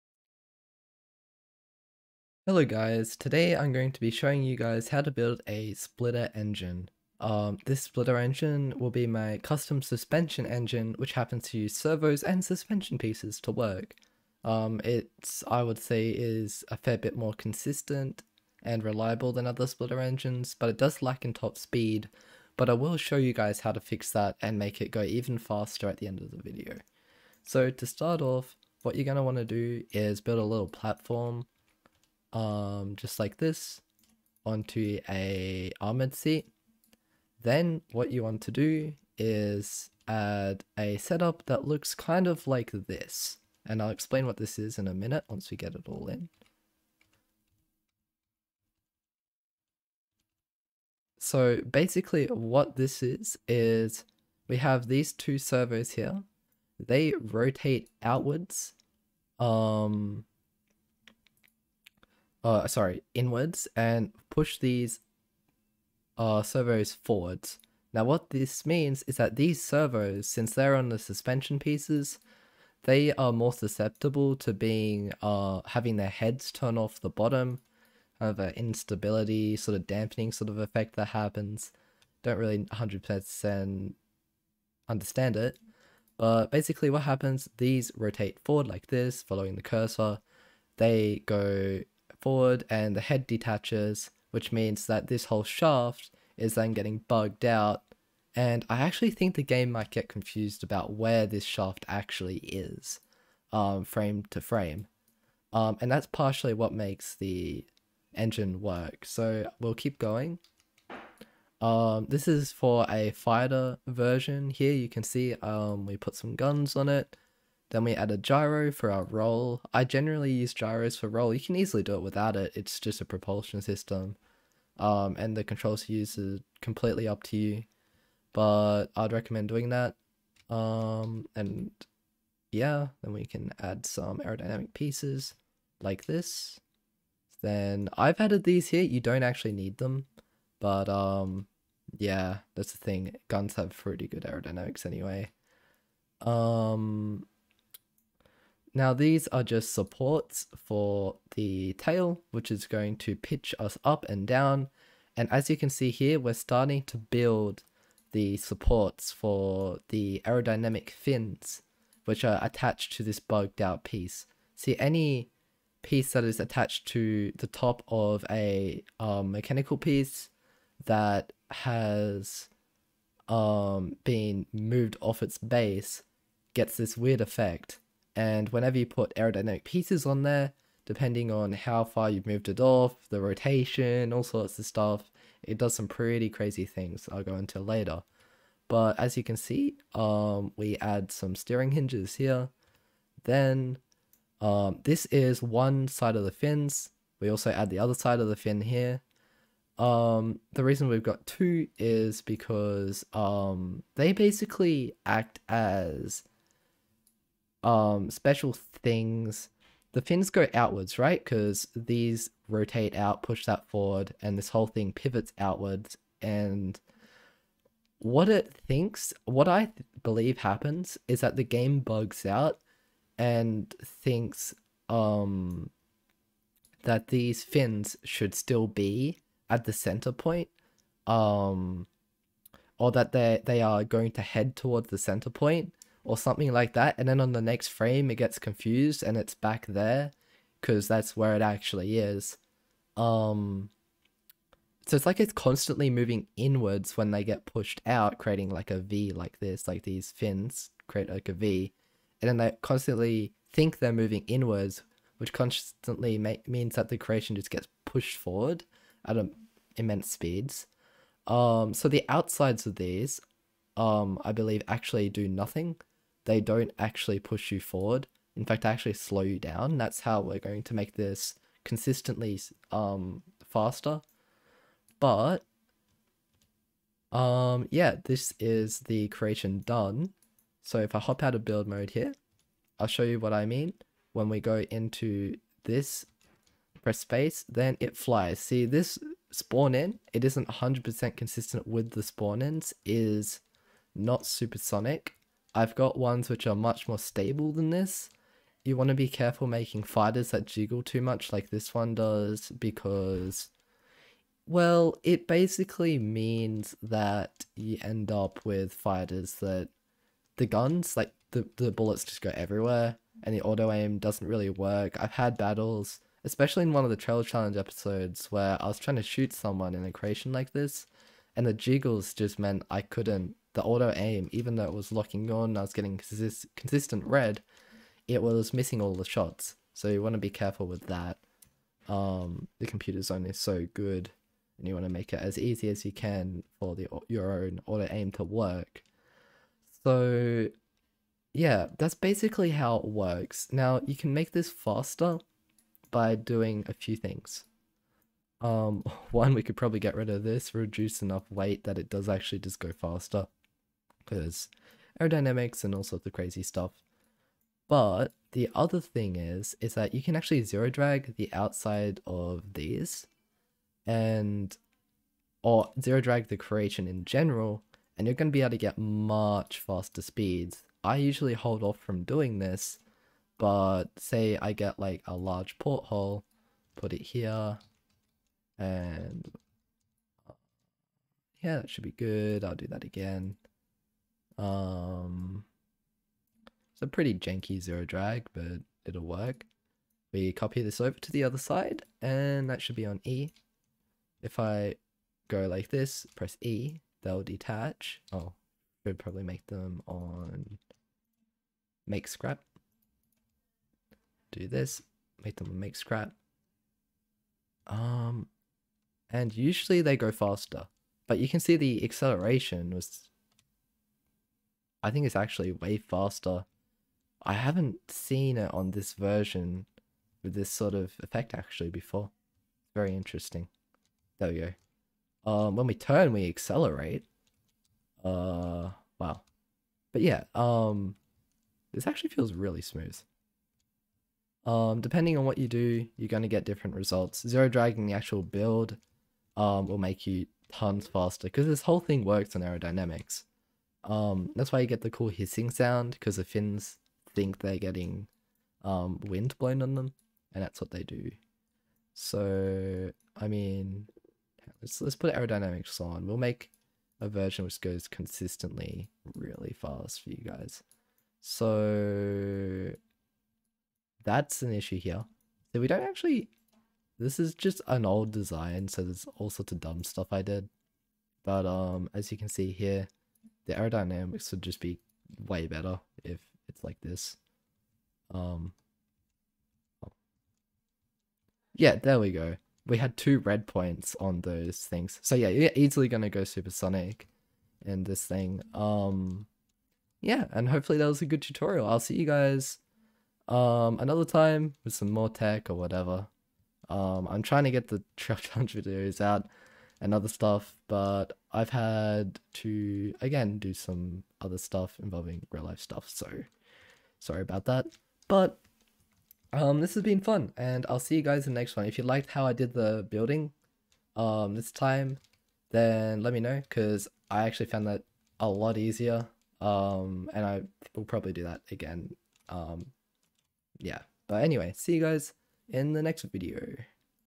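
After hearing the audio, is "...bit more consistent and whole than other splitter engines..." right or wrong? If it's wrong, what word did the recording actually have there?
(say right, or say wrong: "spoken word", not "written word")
wrong: "reliable", not "whole".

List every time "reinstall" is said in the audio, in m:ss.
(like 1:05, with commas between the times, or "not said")
not said.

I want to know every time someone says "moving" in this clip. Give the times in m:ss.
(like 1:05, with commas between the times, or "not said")
4:05, 4:13.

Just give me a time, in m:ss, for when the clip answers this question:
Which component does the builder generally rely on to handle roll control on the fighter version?
2:00.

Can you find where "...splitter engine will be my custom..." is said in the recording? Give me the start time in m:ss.
0:07.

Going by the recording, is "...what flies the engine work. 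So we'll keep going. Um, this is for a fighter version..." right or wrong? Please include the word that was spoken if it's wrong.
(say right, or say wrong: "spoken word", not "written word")
wrong: "makes", not "flies".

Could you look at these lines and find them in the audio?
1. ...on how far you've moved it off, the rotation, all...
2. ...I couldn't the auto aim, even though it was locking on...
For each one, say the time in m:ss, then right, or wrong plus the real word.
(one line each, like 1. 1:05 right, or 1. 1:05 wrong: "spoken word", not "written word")
1. 3:01 right
2. 5:22 right.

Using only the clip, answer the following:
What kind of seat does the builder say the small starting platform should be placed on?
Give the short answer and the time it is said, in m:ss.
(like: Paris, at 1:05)
Armored seat, at 0:35.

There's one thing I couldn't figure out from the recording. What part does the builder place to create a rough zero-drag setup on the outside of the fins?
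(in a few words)
Large porthole.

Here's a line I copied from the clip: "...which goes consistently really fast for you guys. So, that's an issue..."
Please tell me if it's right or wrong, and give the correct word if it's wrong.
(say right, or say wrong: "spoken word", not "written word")
right.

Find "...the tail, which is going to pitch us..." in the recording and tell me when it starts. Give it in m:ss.
2:31.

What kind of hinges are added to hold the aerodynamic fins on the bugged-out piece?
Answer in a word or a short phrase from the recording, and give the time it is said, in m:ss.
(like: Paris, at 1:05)
Steering hinges, at 3:11.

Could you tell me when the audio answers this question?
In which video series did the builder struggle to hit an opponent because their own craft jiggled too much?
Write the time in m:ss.
5:16.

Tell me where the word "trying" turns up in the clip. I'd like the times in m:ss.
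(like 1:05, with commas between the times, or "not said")
5:18, 8:17.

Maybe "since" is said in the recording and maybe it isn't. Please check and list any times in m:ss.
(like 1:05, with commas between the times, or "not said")
1:10.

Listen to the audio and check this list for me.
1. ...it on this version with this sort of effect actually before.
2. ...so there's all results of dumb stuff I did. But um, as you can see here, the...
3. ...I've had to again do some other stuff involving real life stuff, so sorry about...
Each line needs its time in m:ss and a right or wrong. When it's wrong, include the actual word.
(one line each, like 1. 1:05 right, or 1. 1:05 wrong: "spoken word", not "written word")
1. 6:58 right
2. 7:48 wrong: "sorts", not "results"
3. 8:21 right.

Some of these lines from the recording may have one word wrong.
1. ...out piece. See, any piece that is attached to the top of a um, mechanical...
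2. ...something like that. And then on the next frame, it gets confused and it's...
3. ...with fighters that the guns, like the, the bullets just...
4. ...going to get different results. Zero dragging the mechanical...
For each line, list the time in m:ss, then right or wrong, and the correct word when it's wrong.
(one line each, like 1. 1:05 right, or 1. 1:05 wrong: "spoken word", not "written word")
1. 2:43 right
2. 3:56 right
3. 5:08 right
4. 7:16 wrong: "actual", not "mechanical".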